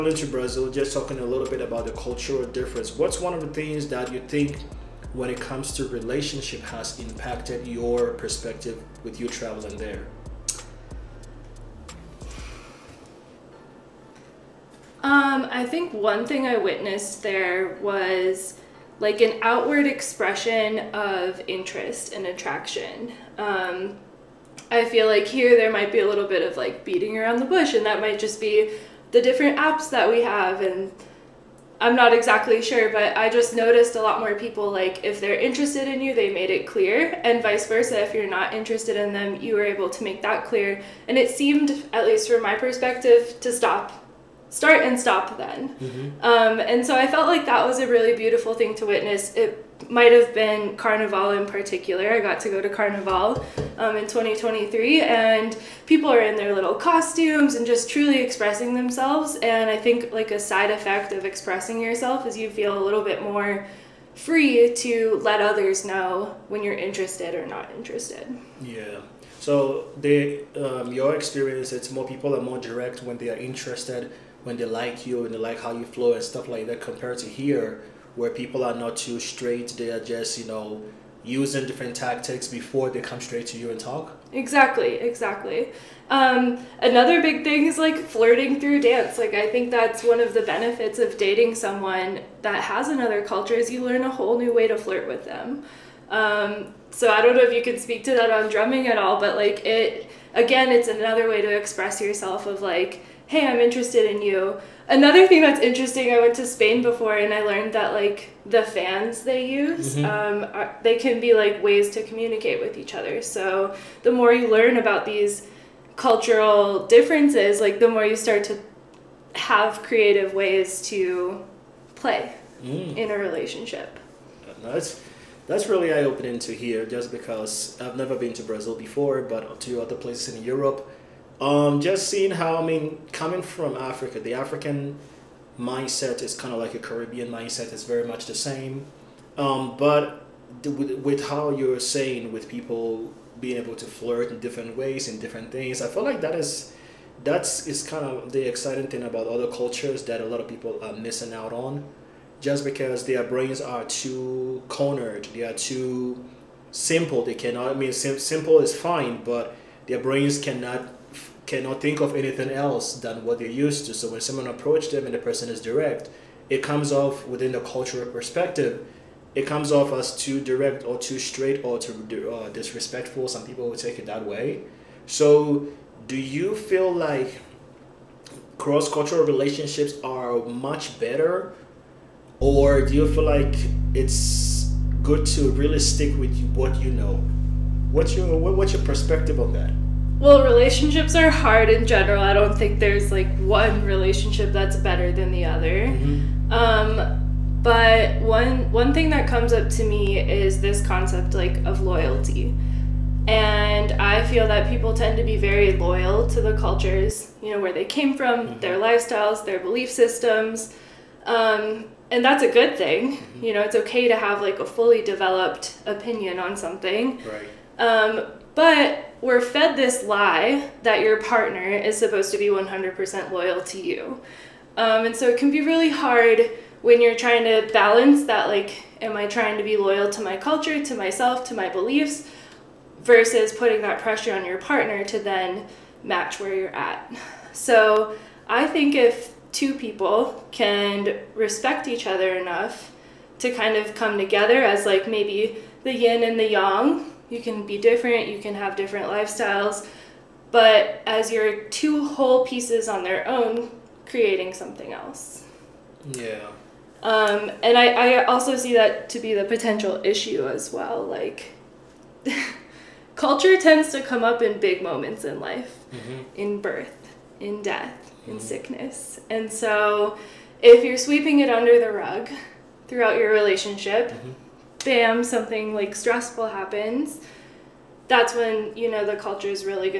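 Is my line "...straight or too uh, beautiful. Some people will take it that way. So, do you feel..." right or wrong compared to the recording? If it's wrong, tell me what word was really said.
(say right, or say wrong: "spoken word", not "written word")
wrong: "disrespectful", not "beautiful".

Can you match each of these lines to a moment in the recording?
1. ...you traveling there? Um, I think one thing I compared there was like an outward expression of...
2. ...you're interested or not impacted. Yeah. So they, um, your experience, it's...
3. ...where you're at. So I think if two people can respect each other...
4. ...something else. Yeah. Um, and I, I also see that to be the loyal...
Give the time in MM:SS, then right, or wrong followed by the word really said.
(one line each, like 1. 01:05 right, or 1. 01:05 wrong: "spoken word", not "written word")
1. 00:09 wrong: "witnessed", not "compared"
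2. 01:06 wrong: "interested", not "impacted"
3. 03:56 right
4. 04:14 wrong: "potential", not "loyal".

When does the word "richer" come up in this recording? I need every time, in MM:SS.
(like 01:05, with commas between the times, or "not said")
not said.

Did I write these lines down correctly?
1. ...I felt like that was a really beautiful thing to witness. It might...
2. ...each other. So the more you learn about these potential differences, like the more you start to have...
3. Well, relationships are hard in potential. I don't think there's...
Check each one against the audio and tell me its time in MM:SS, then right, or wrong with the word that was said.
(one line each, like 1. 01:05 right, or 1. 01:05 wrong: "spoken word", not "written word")
1. 00:46 right
2. 01:52 wrong: "cultural", not "potential"
3. 03:10 wrong: "general", not "potential".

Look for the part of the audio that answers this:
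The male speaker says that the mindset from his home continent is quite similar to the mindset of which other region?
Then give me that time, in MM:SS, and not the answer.
02:16.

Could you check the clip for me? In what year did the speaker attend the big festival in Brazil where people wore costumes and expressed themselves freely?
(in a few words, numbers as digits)
2023.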